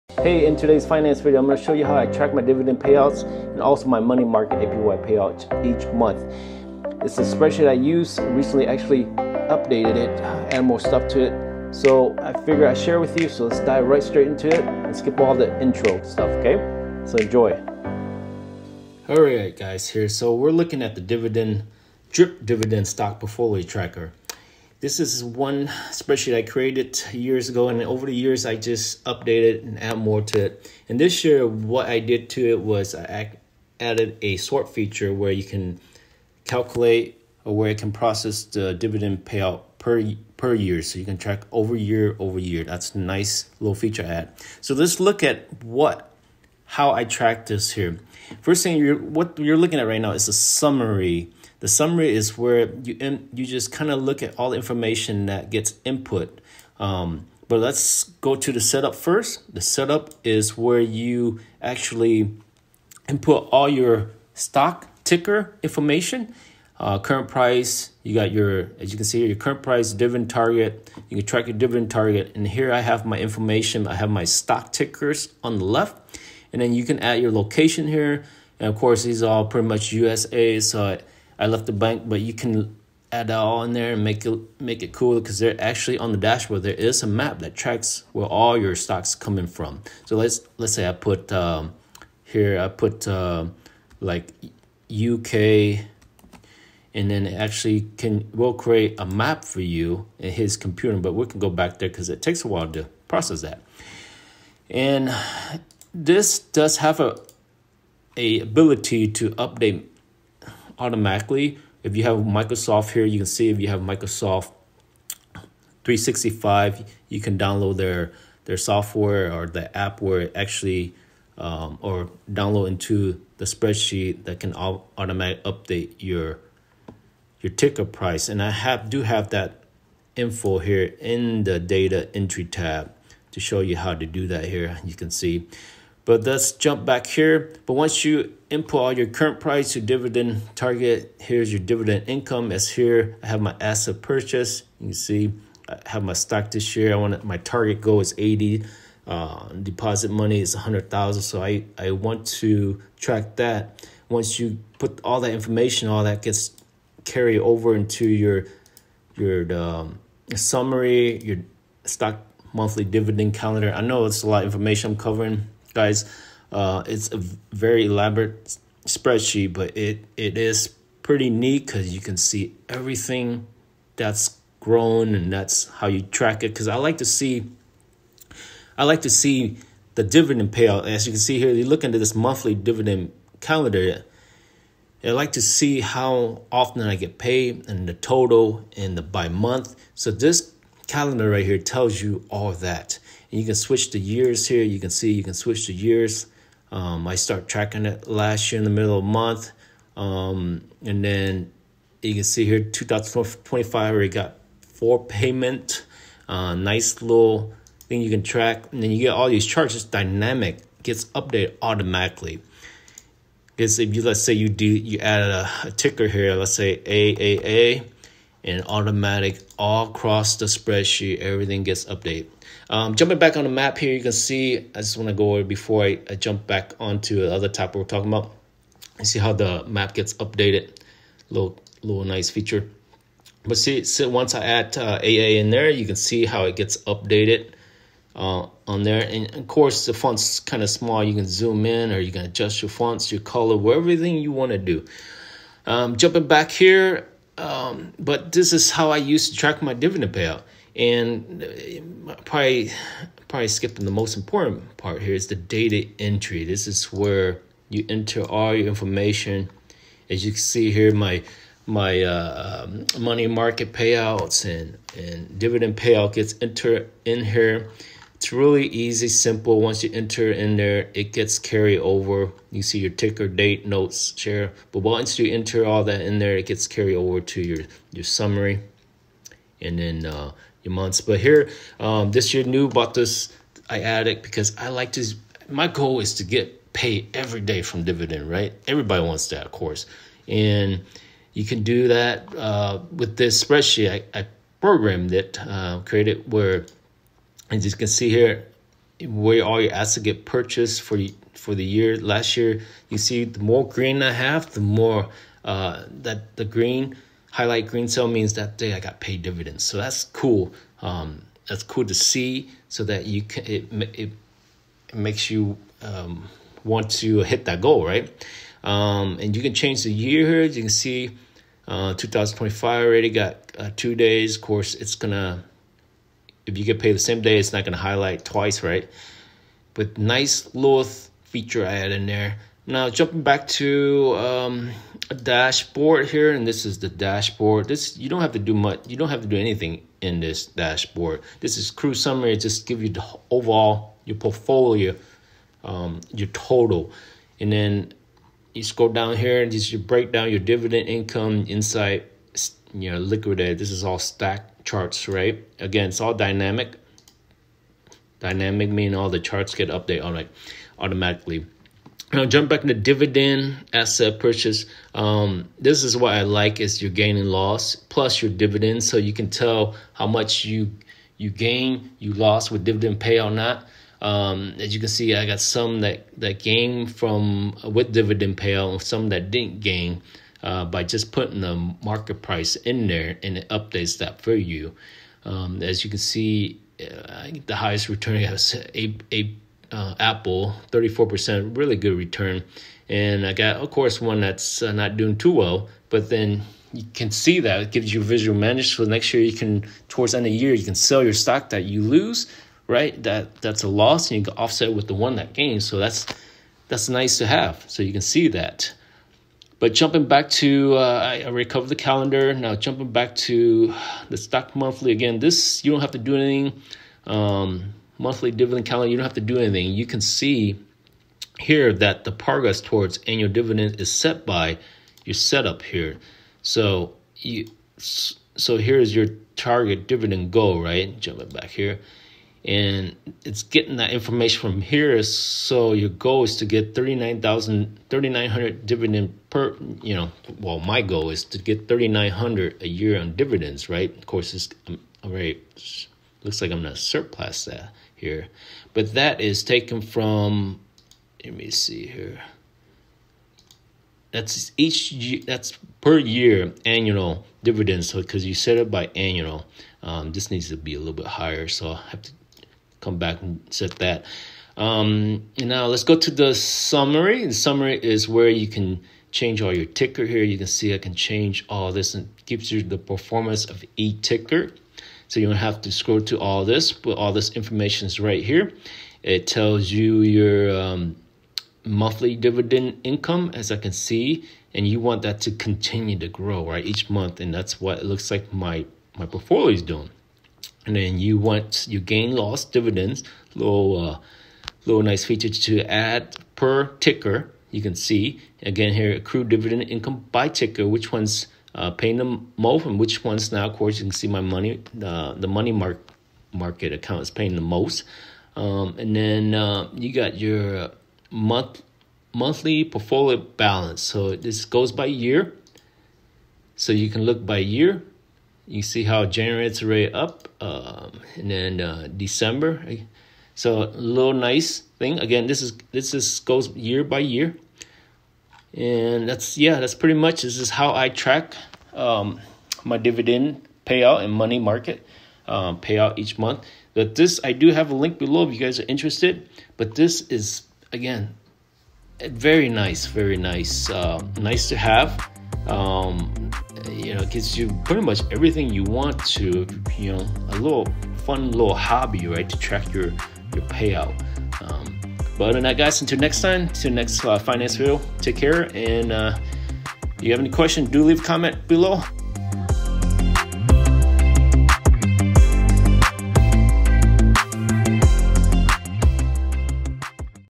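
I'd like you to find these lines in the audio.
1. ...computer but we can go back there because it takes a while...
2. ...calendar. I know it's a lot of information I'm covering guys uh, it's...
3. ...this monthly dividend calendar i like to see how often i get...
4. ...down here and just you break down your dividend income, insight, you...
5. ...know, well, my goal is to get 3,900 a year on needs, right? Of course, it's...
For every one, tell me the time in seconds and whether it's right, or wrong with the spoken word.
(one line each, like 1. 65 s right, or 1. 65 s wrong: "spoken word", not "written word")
1. 100 s right
2. 163 s right
3. 181 s right
4. 348 s right
5. 439 s wrong: "dividends", not "needs".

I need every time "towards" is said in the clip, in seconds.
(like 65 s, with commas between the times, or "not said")
399 s, 422 s.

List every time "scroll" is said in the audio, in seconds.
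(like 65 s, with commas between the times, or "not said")
348 s, 475 s.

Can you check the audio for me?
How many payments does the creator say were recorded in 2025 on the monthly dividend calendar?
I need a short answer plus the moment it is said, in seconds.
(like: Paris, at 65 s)
4, at 204 s.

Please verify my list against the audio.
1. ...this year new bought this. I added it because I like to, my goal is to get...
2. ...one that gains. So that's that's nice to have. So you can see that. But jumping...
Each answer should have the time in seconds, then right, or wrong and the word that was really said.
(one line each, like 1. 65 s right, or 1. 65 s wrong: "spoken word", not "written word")
1. 282 s right
2. 404 s right.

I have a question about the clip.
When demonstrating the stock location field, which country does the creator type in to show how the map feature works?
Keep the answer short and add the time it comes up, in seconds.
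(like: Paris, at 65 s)
UK, at 94 s.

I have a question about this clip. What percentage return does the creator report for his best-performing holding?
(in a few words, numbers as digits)
34%.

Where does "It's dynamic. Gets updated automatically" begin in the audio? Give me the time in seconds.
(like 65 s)
209 s.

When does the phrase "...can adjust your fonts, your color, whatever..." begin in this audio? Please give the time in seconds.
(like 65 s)
242 s.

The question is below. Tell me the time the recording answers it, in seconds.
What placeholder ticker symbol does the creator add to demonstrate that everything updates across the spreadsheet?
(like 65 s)
216 s.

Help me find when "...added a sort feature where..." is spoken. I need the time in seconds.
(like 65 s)
33 s.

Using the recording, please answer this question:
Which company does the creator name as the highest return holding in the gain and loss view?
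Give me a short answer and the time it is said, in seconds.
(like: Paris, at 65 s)
Apple, at 389 s.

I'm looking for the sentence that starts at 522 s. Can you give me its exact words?
Eh, so a little nice thing.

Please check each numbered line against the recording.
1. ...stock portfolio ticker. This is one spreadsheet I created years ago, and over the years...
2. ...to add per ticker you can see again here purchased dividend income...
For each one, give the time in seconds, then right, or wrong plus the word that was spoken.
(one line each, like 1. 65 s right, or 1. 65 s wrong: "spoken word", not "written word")
1. 22 s wrong: "tracker", not "ticker"
2. 495 s wrong: "accrued", not "purchased".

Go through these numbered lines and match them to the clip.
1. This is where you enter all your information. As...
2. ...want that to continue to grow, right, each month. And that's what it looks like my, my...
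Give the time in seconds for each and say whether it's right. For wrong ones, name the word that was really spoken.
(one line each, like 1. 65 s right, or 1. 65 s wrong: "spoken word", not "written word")
1. 256 s right
2. 484 s right.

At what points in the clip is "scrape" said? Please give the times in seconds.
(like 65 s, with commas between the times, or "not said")
not said.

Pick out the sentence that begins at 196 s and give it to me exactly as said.
Um, I start tracking it last year in the middle of the month.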